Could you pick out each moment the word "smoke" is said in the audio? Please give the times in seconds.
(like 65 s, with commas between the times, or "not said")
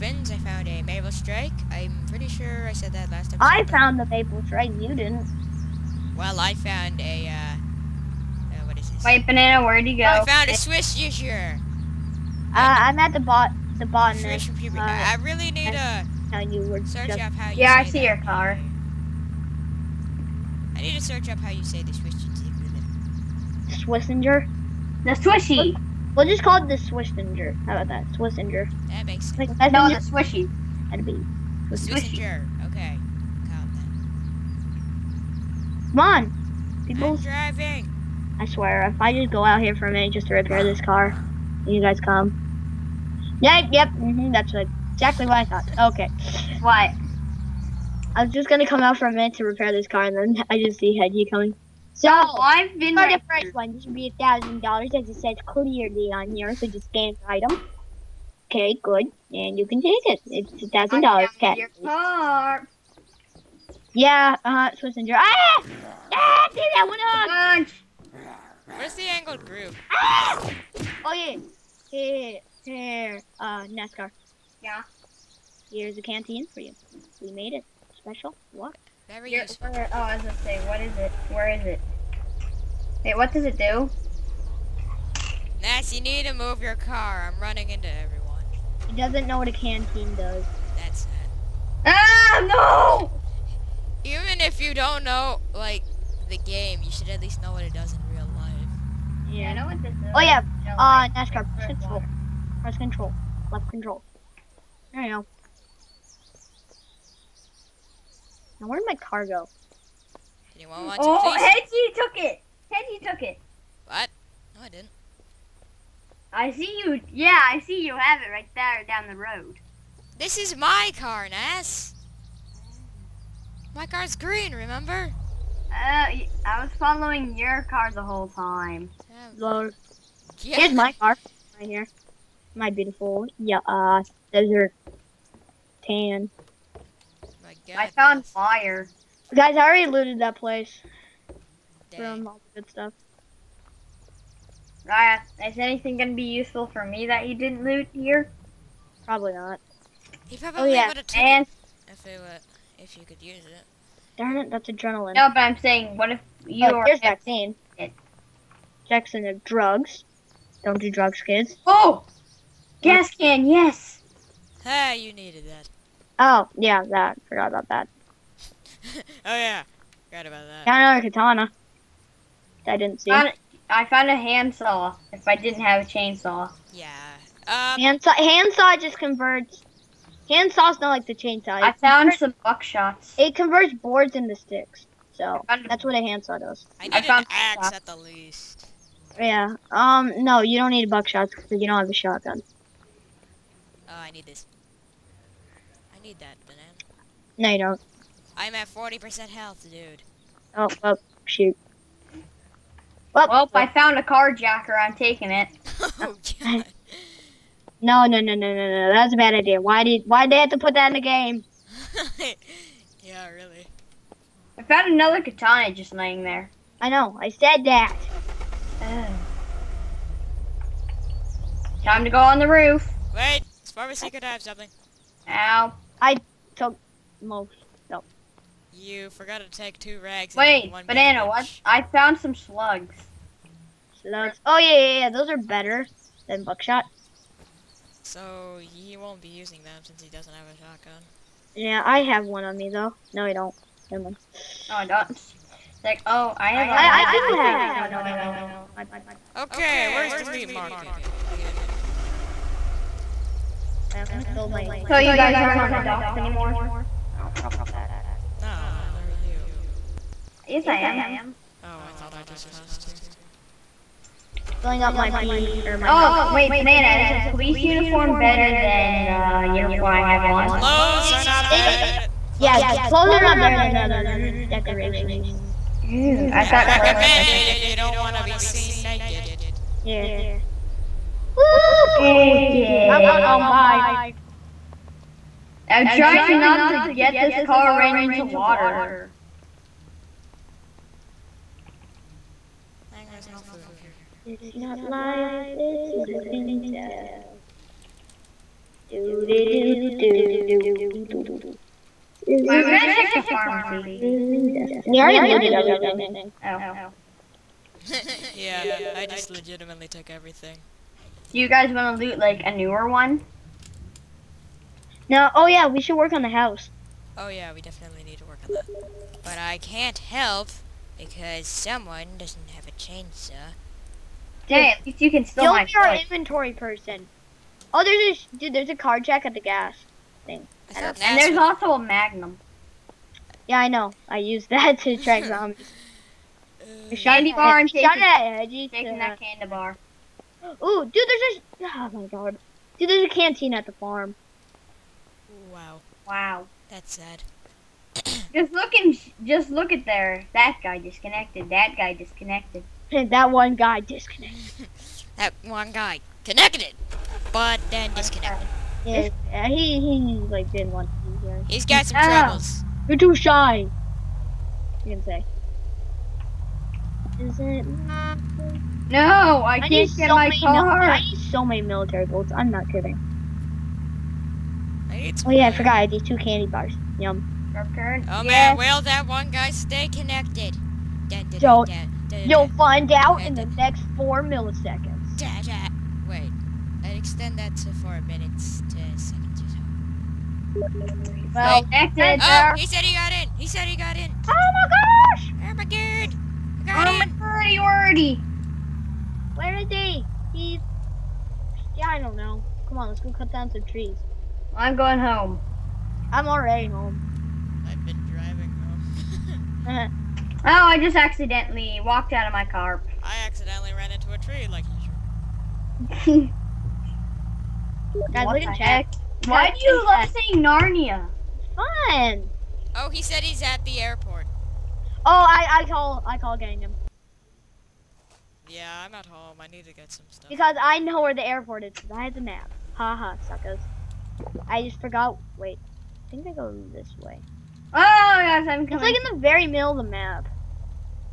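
not said.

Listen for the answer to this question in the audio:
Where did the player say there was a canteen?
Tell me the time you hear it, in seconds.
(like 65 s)
343 s.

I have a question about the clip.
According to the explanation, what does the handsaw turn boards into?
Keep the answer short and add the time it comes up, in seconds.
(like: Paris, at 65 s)
Sticks, at 184 s.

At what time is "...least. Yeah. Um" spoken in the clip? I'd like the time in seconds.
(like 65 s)
187 s.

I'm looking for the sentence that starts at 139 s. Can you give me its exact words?
Guys, I already looted that place.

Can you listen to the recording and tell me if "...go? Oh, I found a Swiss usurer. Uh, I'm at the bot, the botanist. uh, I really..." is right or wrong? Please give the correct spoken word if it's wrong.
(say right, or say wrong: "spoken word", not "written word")
right.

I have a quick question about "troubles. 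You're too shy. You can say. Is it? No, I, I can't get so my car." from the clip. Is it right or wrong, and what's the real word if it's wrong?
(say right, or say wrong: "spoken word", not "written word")
right.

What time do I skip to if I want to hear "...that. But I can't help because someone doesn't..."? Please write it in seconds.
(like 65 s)
318 s.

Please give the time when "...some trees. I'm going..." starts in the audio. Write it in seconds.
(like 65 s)
403 s.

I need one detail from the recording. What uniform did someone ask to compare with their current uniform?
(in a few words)
Police uniform.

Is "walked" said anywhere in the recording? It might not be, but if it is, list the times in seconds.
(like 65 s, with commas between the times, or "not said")
411 s.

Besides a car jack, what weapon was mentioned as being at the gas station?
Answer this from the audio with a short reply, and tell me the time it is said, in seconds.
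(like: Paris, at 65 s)
Magnum, at 331 s.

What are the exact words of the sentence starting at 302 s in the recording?
Is I'm gonna check the pharmacy.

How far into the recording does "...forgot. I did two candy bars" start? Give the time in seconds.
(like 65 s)
375 s.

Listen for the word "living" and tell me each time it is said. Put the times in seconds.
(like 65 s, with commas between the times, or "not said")
295 s, 303 s.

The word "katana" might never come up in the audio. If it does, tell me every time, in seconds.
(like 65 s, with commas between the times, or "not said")
171 s, 215 s.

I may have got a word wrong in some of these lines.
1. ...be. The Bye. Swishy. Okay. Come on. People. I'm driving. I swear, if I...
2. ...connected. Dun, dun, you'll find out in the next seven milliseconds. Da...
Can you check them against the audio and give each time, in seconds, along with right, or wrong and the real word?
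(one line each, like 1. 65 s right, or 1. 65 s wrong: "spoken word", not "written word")
1. 31 s wrong: "Swissinger", not "Bye"
2. 379 s wrong: "four", not "seven".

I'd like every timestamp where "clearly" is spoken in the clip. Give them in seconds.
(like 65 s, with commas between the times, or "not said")
55 s.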